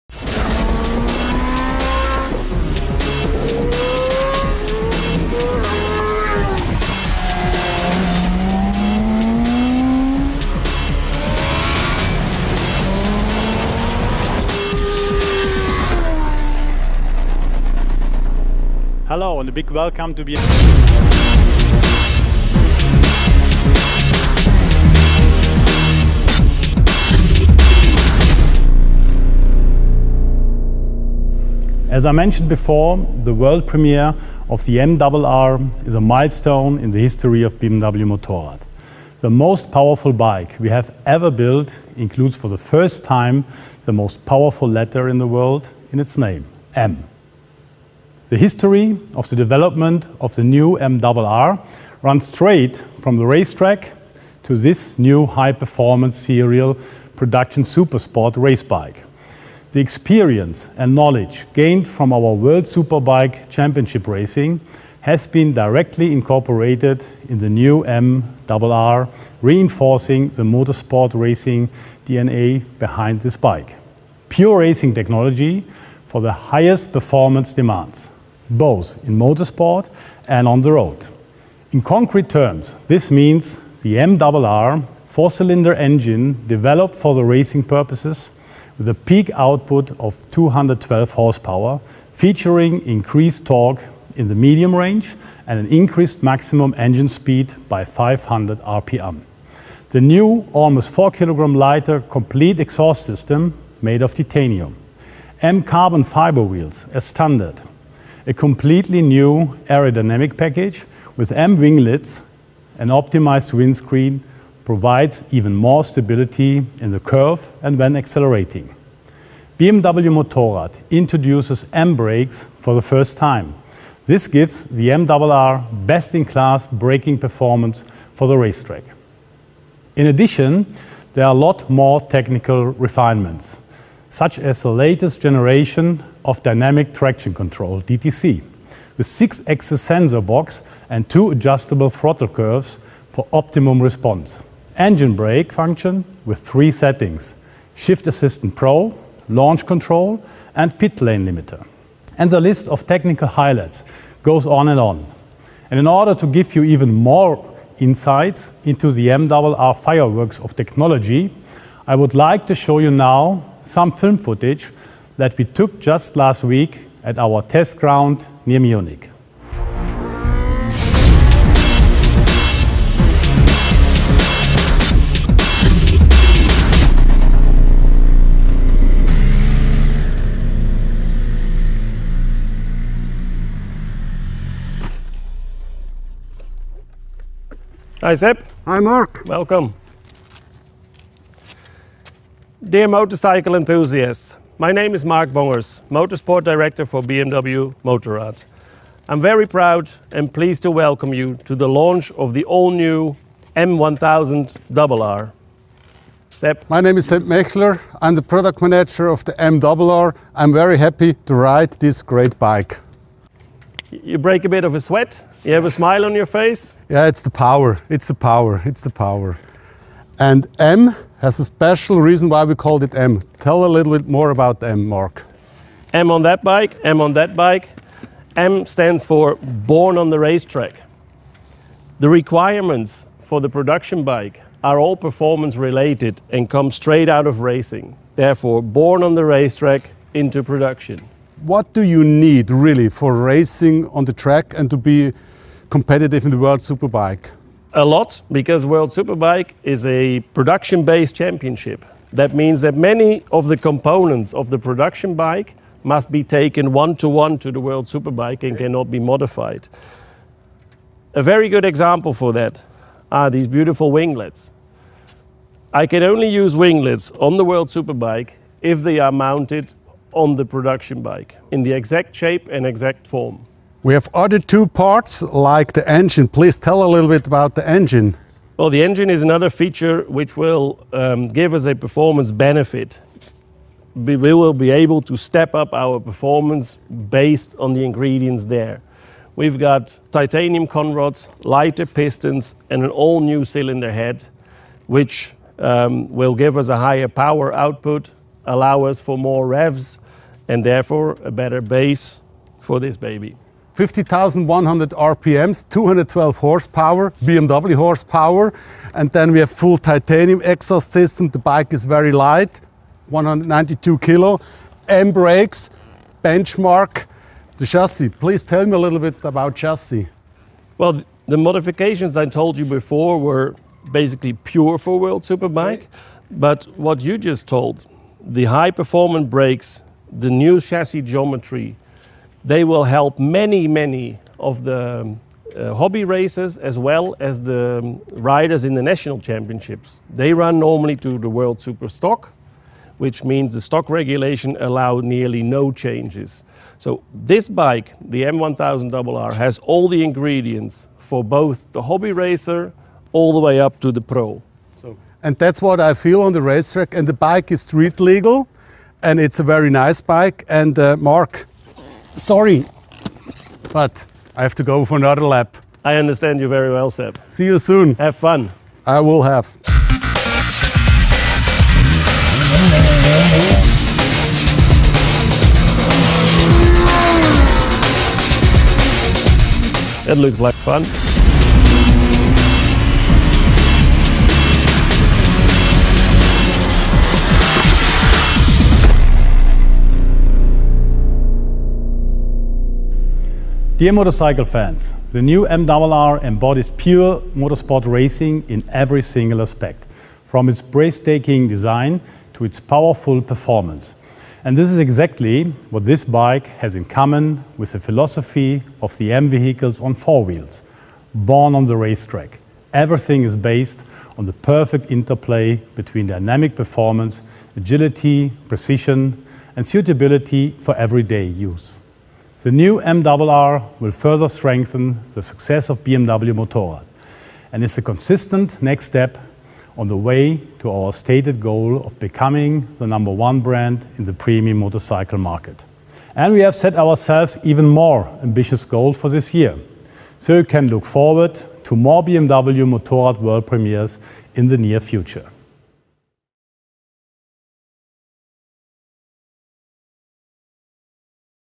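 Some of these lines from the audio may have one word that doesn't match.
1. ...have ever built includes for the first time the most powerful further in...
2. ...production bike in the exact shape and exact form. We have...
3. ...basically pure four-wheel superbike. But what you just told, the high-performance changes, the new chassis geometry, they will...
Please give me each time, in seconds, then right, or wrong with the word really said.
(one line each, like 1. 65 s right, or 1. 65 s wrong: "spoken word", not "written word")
1. 40 s wrong: "letter", not "further"
2. 270 s right
3. 323 s wrong: "brakes", not "changes".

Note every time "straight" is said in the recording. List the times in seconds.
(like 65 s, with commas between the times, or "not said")
52 s, 236 s.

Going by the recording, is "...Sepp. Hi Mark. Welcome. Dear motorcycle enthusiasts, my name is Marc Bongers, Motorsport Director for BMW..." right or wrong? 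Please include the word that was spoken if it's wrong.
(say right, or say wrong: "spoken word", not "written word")
right.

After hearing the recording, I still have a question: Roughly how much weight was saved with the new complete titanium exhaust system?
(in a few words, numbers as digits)
almost 4 kg.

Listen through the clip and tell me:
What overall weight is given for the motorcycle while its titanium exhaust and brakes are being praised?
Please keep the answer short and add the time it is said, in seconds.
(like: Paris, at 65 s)
192 kg, at 313 s.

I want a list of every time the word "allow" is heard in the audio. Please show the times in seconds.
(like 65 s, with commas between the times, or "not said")
298 s, 344 s.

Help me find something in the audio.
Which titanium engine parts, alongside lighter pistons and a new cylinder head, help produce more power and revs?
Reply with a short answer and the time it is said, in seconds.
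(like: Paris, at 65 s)
titanium conrods, at 290 s.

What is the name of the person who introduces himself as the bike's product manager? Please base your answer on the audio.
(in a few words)
Sepp Mechler.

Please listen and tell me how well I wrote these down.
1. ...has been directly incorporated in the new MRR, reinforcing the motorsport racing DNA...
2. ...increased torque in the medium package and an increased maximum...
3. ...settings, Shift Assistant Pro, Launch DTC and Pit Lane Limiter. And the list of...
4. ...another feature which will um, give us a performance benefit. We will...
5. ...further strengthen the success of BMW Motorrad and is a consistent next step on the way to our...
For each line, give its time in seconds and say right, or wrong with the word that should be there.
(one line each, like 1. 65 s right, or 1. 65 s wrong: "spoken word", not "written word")
1. 65 s right
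2. 92 s wrong: "range", not "package"
3. 146 s wrong: "Control", not "DTC"
4. 279 s right
5. 423 s right.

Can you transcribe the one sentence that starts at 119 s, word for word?
BMW Motorrad introduces M brakes for the first time.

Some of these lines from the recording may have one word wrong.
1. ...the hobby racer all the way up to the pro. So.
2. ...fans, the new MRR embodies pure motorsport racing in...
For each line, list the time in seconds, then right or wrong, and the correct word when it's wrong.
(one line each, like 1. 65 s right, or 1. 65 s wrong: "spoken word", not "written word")
1. 351 s right
2. 394 s right.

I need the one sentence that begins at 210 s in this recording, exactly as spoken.
I'm very happy to ride this great bike.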